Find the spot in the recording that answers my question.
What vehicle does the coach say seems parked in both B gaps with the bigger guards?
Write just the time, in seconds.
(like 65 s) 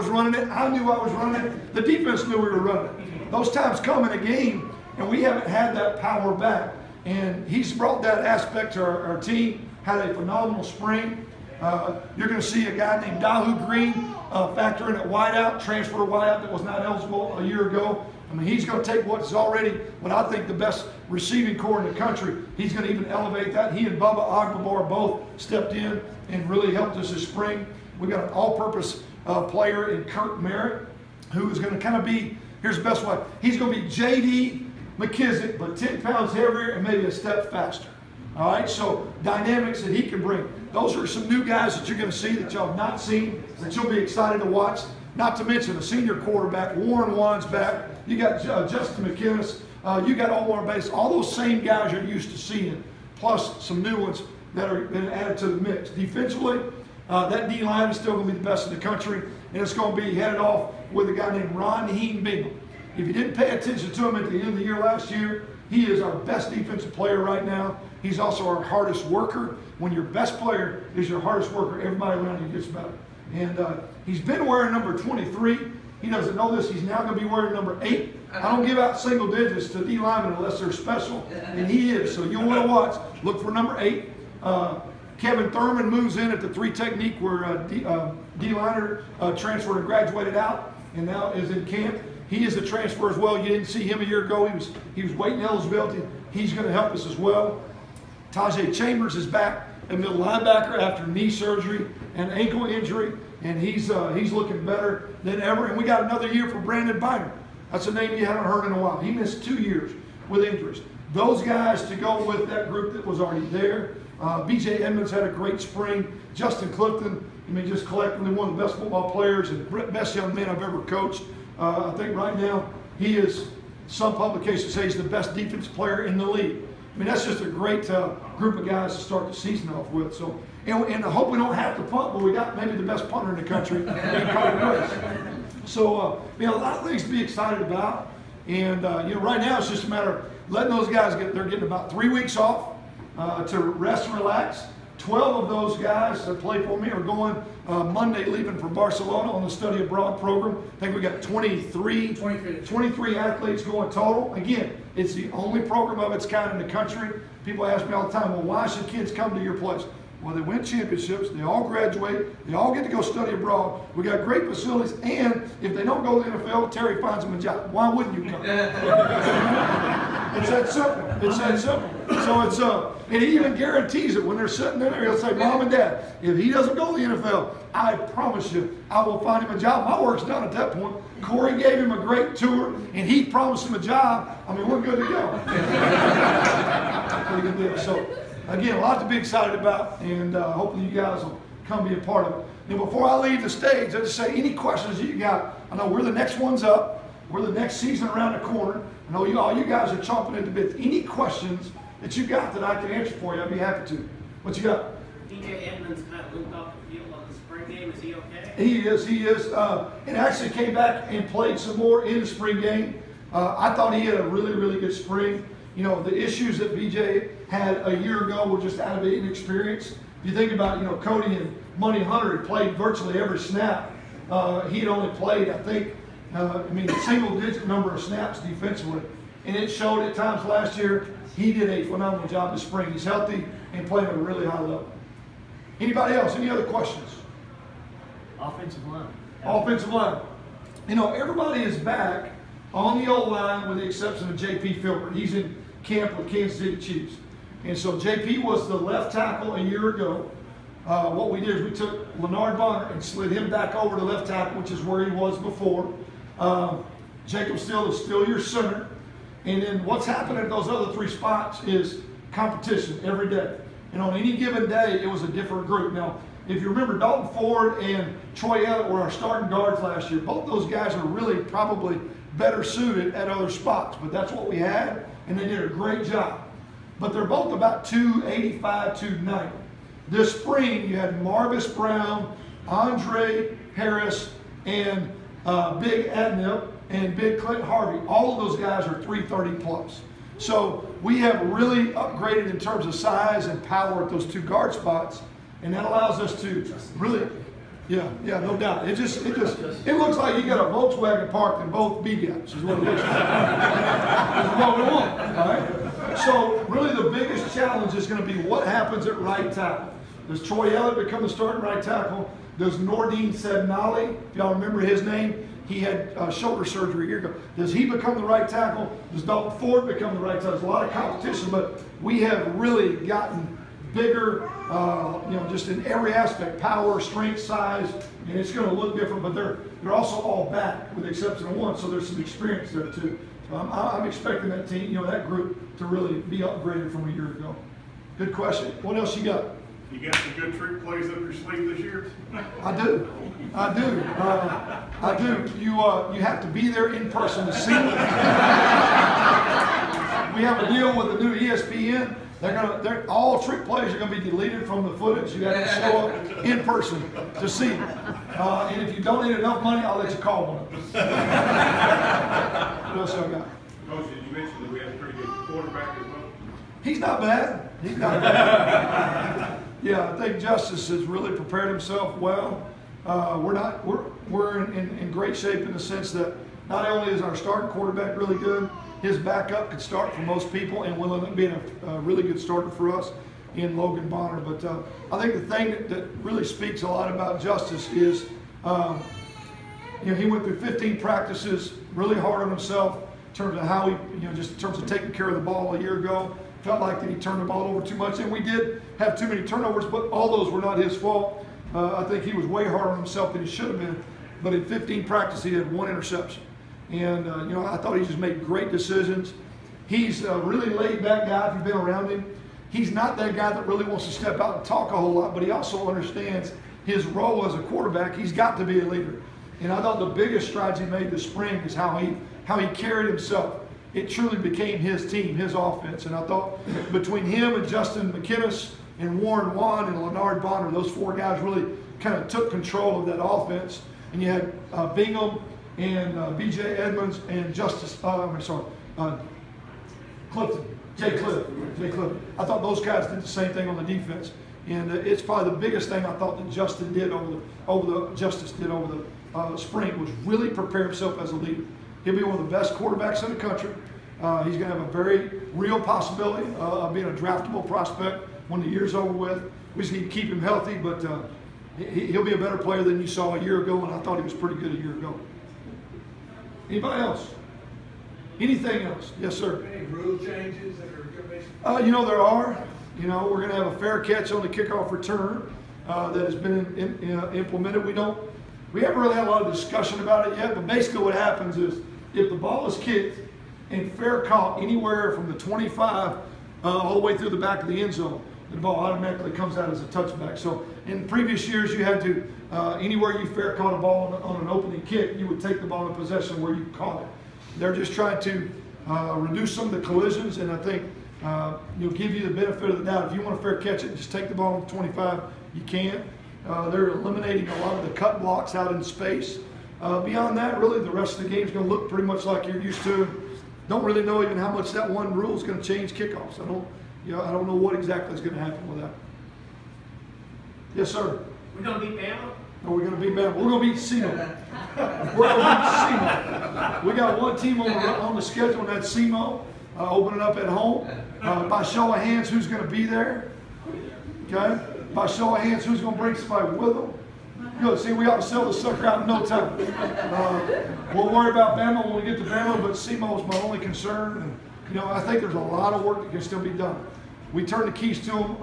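300 s.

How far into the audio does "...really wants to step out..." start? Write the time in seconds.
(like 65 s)
413 s.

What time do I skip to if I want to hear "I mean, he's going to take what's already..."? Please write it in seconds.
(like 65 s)
18 s.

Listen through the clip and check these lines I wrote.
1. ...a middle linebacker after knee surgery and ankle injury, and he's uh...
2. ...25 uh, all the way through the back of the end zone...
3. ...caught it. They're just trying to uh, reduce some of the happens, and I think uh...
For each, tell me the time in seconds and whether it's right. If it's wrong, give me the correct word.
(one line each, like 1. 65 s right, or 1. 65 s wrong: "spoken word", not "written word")
1. 99 s right
2. 485 s right
3. 496 s wrong: "collisions", not "happens".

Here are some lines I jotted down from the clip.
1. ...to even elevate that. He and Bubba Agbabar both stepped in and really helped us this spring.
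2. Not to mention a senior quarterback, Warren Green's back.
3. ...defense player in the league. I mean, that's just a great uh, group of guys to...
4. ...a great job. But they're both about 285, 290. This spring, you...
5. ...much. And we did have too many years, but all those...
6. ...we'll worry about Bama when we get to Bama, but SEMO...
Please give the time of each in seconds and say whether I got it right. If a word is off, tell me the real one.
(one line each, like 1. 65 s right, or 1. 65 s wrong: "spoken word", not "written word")
1. 22 s right
2. 45 s wrong: "Wand", not "Green"
3. 125 s right
4. 275 s right
5. 397 s wrong: "turnovers", not "years"
6. 540 s right.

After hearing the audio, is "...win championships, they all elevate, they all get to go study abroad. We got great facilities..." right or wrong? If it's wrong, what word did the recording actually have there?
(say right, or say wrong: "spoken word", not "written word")
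wrong: "graduate", not "elevate".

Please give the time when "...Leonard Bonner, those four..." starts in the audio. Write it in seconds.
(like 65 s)
430 s.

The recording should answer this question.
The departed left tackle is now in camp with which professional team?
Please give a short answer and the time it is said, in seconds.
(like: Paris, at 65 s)
Kansas City Chiefs, at 246 s.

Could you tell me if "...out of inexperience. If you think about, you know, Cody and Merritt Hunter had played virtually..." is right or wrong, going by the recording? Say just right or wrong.
wrong.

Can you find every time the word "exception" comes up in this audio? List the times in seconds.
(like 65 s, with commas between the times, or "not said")
243 s, 331 s.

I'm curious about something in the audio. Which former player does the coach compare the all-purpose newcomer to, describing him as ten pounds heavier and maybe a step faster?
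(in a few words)
J.D. McKissic.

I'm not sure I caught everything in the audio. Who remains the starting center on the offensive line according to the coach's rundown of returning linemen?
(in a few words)
Jacob Steele.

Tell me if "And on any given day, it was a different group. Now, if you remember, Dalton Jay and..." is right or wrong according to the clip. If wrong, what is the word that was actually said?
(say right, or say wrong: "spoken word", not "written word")
wrong: "Ford", not "Jay".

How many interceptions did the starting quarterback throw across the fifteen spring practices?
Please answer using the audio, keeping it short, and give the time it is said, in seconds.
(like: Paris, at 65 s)
1, at 405 s.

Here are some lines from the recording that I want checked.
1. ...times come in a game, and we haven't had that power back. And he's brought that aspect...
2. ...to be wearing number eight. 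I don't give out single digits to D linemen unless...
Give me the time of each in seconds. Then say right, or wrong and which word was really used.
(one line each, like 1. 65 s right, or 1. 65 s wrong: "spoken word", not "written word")
1. 3 s right
2. 77 s right.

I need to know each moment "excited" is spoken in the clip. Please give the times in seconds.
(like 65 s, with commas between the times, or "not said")
43 s, 137 s, 189 s.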